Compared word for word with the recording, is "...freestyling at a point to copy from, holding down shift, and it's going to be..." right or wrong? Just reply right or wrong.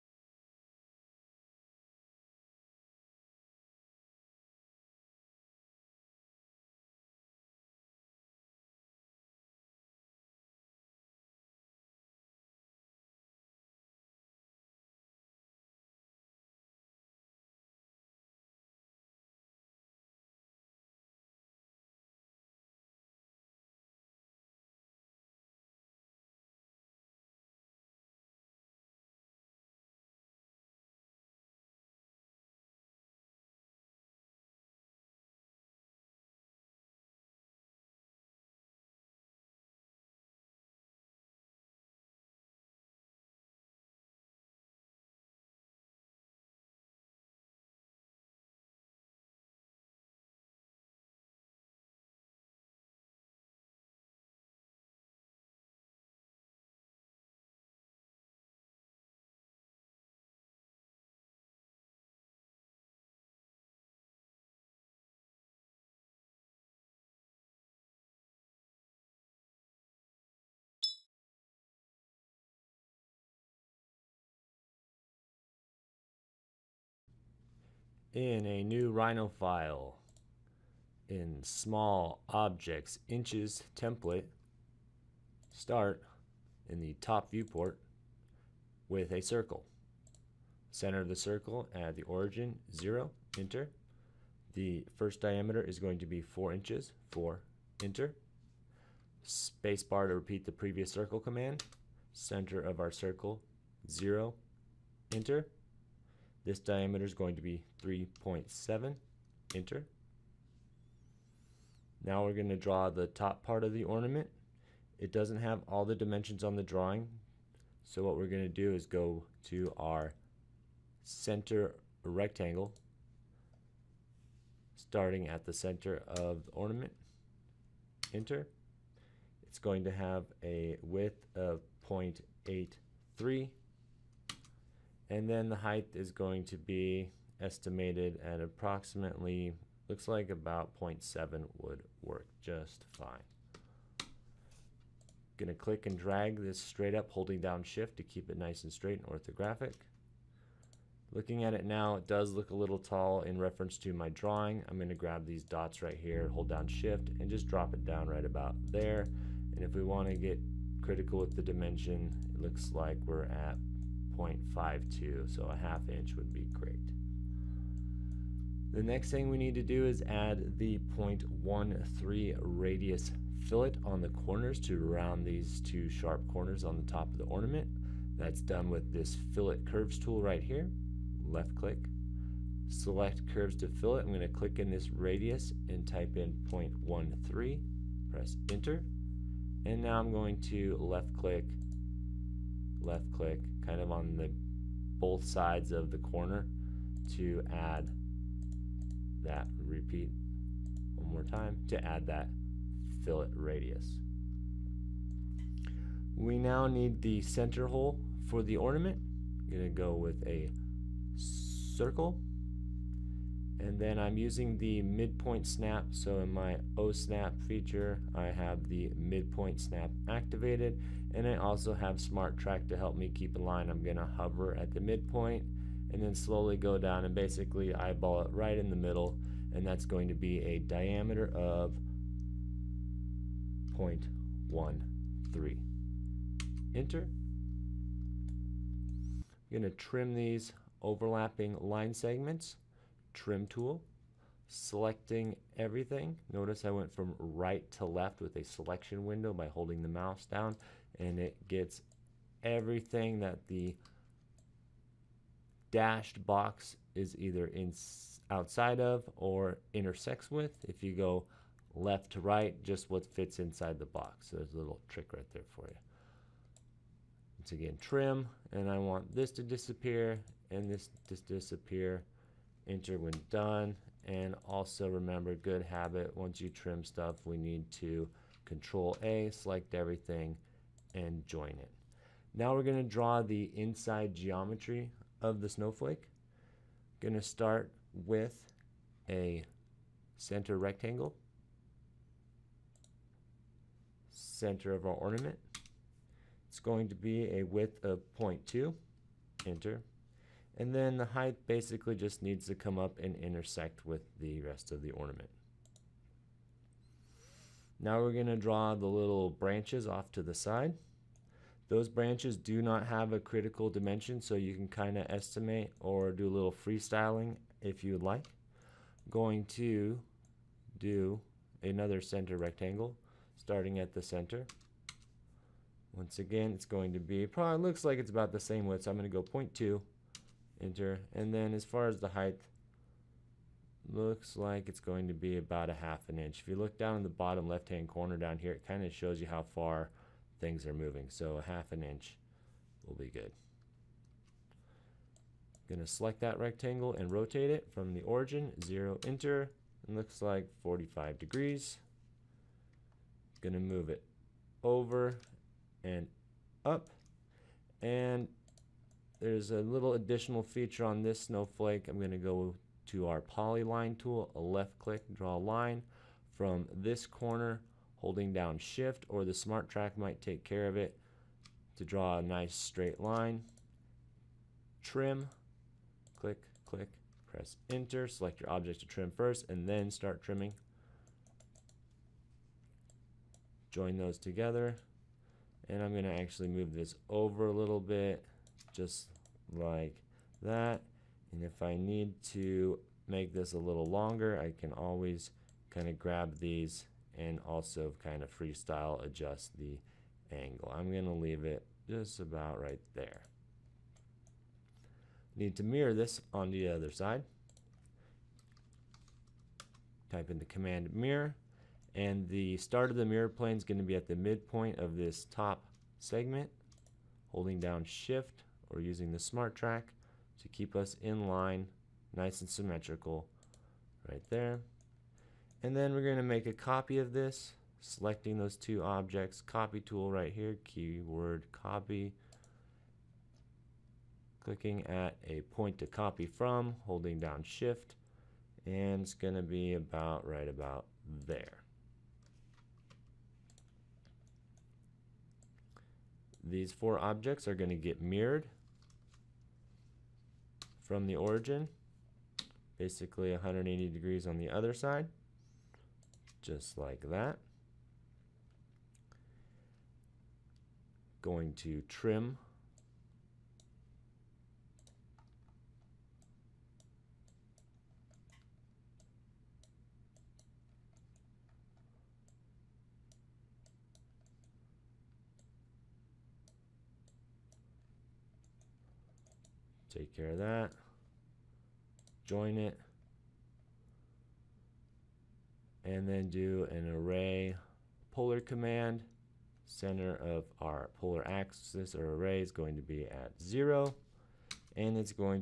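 wrong.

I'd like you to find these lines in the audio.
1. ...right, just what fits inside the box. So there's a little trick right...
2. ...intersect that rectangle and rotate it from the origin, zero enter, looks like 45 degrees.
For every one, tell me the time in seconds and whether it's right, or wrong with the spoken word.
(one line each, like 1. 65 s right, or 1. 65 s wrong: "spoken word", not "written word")
1. 262 s right
2. 345 s wrong: "select", not "intersect".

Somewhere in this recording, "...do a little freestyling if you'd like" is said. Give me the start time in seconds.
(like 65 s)
316 s.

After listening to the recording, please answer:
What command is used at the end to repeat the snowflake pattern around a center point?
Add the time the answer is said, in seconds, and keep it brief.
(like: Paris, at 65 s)
array polar, at 486 s.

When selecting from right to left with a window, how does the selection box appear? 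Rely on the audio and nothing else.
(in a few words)
dashed box.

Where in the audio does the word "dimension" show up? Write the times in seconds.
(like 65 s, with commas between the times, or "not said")
115 s, 161 s, 313 s.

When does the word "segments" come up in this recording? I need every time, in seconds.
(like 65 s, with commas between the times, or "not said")
241 s, 415 s.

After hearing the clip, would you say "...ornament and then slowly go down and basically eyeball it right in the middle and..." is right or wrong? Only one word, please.
wrong.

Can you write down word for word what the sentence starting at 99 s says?
Spacebar to repeat the previous circle command.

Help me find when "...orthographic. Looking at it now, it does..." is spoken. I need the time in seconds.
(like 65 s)
149 s.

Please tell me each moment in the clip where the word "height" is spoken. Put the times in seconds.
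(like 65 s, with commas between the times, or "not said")
135 s, 301 s, 332 s.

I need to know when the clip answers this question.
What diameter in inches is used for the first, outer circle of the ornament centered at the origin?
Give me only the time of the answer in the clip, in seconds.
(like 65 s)
96 s.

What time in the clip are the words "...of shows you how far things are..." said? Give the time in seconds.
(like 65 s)
338 s.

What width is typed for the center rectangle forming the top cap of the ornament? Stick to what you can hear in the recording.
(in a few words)
0.83.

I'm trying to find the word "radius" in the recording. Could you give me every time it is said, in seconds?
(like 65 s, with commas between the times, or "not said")
172 s, 184 s, 203 s.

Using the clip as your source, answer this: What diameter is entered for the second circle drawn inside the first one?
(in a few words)
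3.7.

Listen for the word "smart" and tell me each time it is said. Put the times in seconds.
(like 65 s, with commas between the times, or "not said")
221 s, 369 s, 419 s.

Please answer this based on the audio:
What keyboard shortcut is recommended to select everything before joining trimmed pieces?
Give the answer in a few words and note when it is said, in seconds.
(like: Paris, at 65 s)
Control A, at 278 s.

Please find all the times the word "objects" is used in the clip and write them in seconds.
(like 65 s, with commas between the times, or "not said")
82 s, 378 s, 428 s, 446 s.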